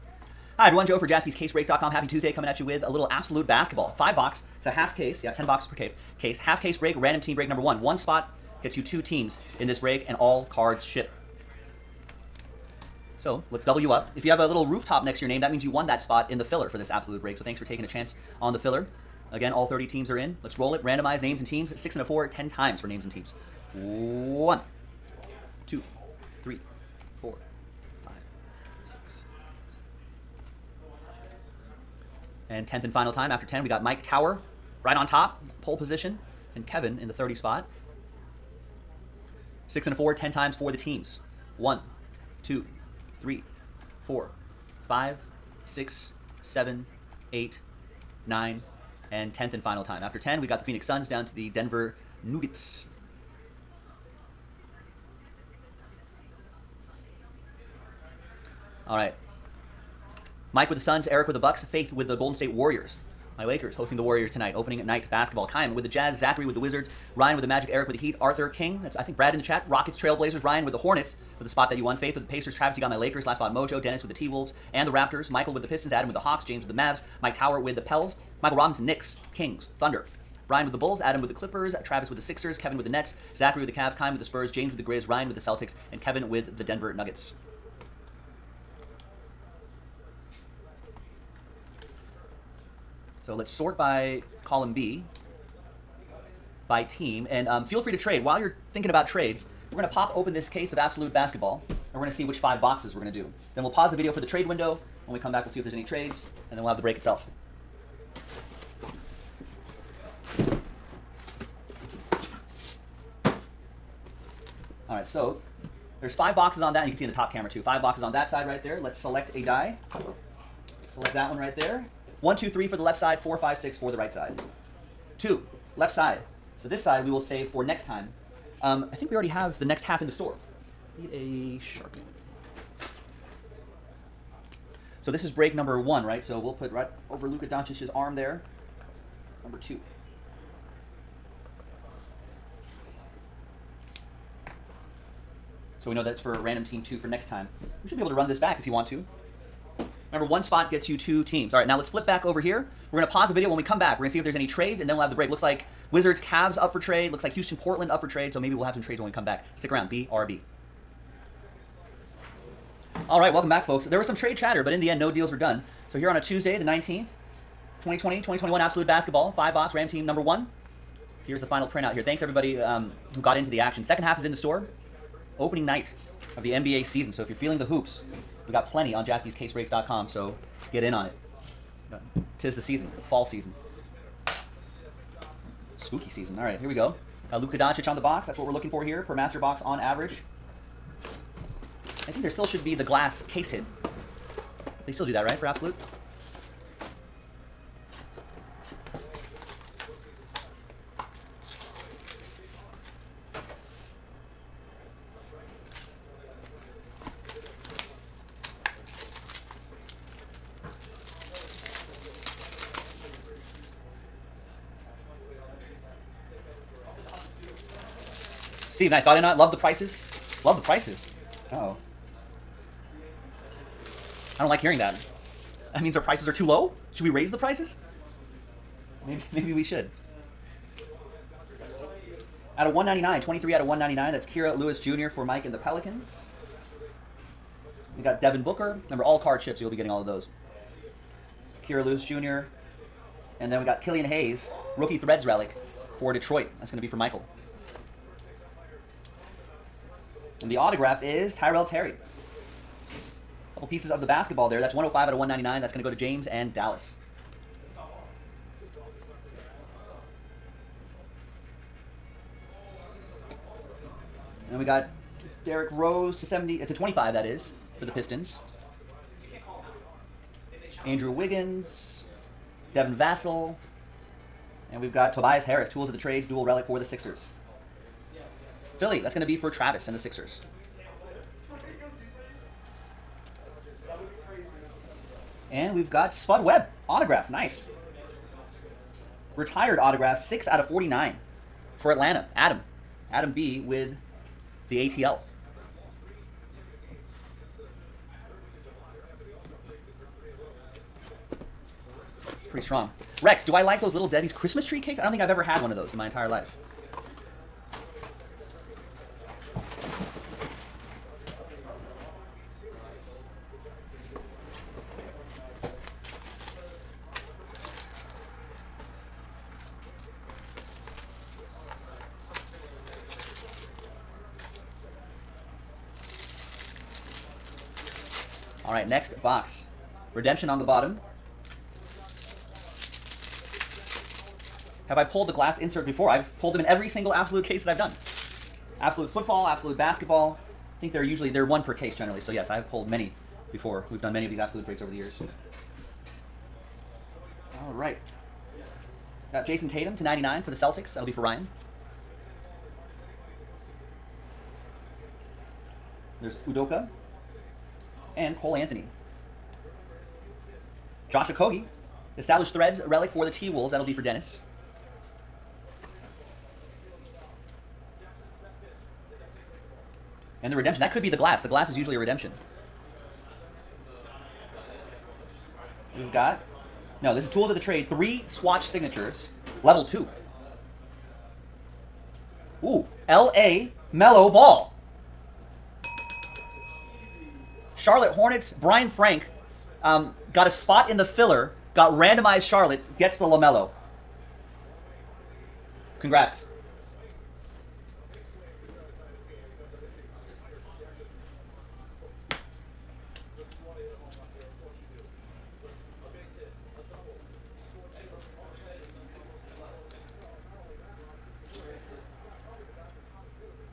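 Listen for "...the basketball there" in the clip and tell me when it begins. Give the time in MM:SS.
04:14.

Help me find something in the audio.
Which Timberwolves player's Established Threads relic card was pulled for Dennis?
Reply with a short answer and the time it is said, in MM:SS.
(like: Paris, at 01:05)
Josh Okogie, at 06:01.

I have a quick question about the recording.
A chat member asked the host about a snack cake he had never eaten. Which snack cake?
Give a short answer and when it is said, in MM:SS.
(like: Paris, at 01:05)
Little Debbie's Christmas tree cakes, at 05:03.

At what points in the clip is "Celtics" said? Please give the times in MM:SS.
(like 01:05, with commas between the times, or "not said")
01:25, 05:50.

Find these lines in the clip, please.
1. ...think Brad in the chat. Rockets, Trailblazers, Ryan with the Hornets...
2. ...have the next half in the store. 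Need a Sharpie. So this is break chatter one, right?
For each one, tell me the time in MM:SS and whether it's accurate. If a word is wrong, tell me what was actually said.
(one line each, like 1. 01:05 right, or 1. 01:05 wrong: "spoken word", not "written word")
1. 01:09 right
2. 02:09 wrong: "number", not "chatter".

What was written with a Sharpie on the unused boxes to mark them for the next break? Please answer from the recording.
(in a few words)
Number two.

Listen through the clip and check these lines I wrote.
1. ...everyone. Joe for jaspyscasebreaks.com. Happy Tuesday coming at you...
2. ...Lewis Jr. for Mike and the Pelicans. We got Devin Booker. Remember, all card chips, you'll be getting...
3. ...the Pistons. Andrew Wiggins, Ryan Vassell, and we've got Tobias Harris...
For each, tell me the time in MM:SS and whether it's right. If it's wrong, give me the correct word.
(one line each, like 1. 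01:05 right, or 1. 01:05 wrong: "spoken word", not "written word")
1. 00:00 right
2. 03:54 right
3. 04:27 wrong: "Devin", not "Ryan".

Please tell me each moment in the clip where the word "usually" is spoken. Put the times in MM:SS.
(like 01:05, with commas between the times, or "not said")
05:41, 06:11.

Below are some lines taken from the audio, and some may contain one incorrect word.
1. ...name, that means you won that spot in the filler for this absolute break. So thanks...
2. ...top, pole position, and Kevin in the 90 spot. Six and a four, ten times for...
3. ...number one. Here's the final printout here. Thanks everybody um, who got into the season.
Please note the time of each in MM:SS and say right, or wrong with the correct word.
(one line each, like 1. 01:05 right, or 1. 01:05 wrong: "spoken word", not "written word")
1. 00:15 right
2. 00:35 wrong: "30", not "90"
3. 02:50 wrong: "action", not "season".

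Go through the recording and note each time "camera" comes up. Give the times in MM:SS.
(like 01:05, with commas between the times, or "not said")
01:57.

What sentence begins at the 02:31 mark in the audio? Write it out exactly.
All right, now let's flip back over here.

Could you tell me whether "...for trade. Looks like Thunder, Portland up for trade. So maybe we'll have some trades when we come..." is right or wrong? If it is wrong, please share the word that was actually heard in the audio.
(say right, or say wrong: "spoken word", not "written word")
wrong: "Houston", not "Thunder".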